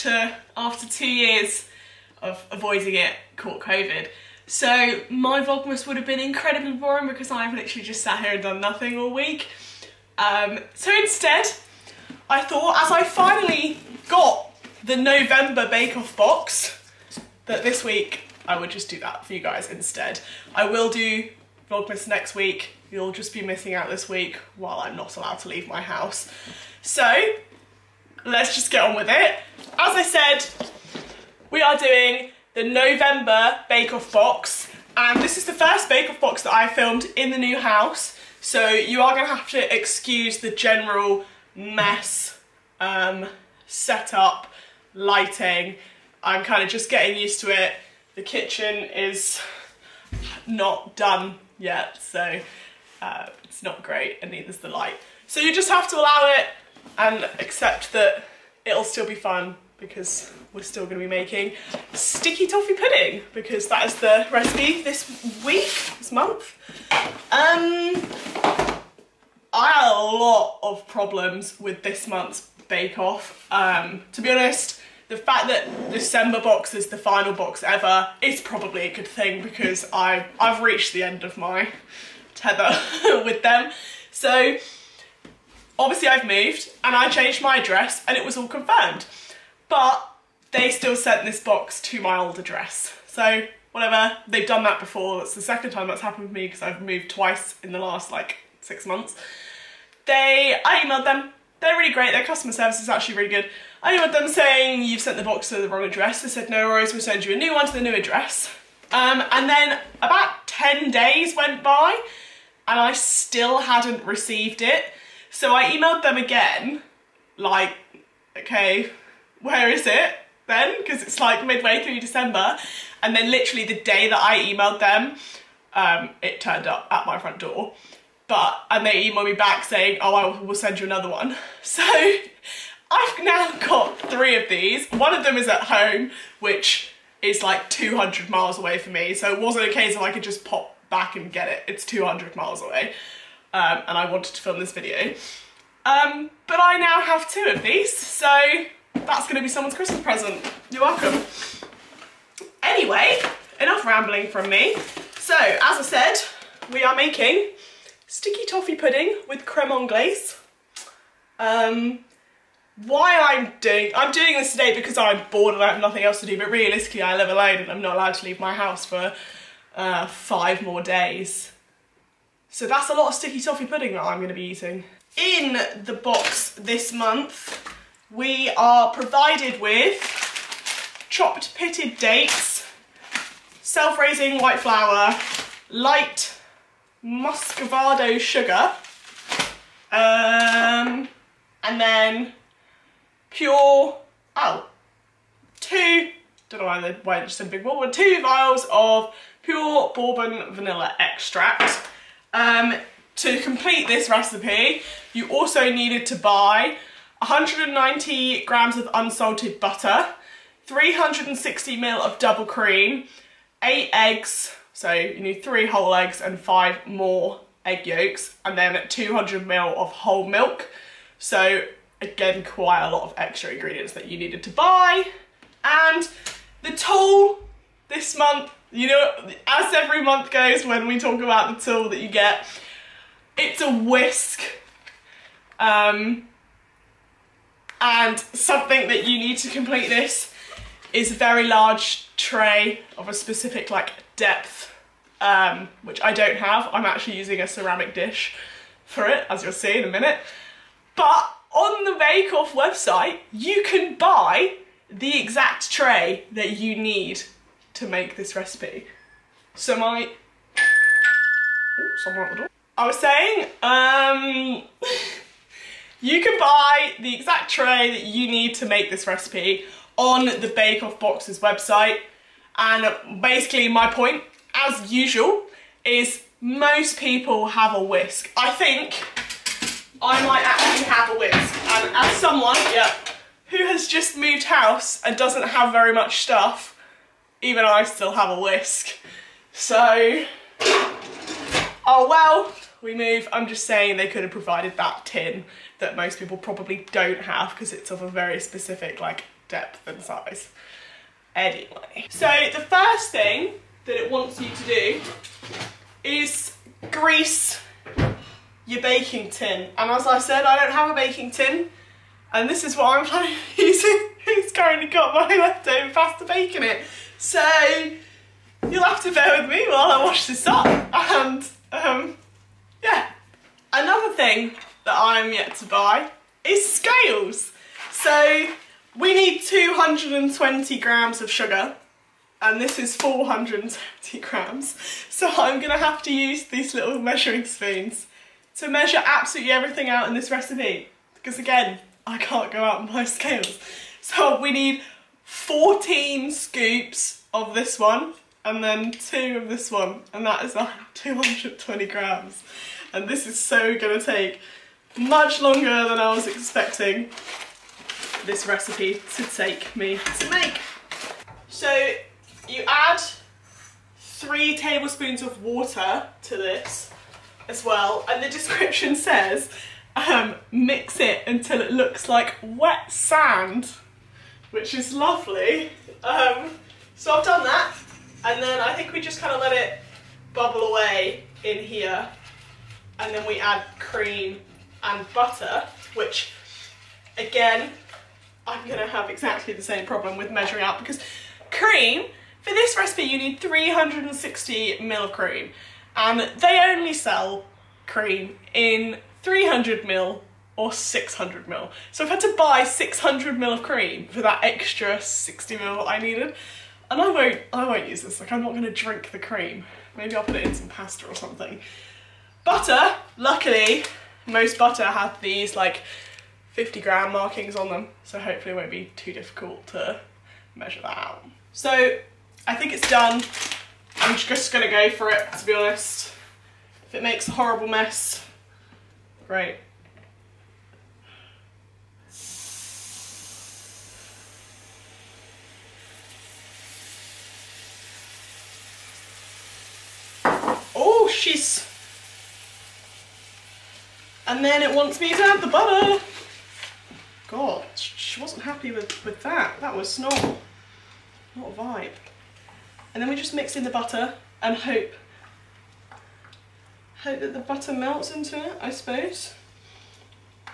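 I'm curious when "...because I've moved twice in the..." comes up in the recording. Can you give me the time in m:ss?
1:36.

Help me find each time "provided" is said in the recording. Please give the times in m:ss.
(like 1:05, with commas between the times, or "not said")
2:58, 4:54.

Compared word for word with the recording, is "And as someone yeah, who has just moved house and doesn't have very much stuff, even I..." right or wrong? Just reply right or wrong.
right.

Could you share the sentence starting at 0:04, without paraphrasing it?
So my Vlogmas would have been incredibly boring because I've literally just sat here and done nothing all week.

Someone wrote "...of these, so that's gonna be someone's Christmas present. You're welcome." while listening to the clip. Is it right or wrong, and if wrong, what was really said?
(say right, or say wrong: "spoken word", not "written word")
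right.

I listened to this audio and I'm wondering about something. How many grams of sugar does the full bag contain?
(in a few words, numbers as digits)
470 grams.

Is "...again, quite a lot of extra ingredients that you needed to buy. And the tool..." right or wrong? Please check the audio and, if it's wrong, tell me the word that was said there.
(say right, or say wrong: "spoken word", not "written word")
right.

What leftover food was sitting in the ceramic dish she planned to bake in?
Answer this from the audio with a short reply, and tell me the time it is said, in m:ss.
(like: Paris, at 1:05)
pasta bake, at 5:15.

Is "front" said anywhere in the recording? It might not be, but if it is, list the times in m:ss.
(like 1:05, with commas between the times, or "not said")
2:07.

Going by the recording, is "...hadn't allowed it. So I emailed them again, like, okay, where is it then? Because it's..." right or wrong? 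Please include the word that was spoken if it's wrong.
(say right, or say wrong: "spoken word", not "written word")
wrong: "received", not "allowed".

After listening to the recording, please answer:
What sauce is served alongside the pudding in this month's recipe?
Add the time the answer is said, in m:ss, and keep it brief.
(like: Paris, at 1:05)
creme anglaise, at 2:39.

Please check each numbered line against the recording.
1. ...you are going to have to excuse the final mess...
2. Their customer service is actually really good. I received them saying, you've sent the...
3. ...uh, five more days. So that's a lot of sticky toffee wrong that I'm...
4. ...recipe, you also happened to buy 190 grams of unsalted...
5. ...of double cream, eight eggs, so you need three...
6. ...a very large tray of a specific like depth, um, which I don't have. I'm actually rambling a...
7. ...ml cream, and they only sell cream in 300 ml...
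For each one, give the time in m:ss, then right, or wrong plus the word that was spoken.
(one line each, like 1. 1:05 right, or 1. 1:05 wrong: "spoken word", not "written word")
1. 0:38 wrong: "general", not "final"
2. 1:42 wrong: "emailed", not "received"
3. 2:49 wrong: "pudding", not "wrong"
4. 3:24 wrong: "needed", not "happened"
5. 3:31 right
6. 4:01 wrong: "using", not "rambling"
7. 6:34 right.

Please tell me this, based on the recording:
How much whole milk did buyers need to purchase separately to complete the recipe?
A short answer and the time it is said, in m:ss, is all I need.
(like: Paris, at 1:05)
200 ml, at 3:38.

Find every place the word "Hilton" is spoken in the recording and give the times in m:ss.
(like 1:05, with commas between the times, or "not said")
not said.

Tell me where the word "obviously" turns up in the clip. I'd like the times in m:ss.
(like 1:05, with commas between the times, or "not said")
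1:25.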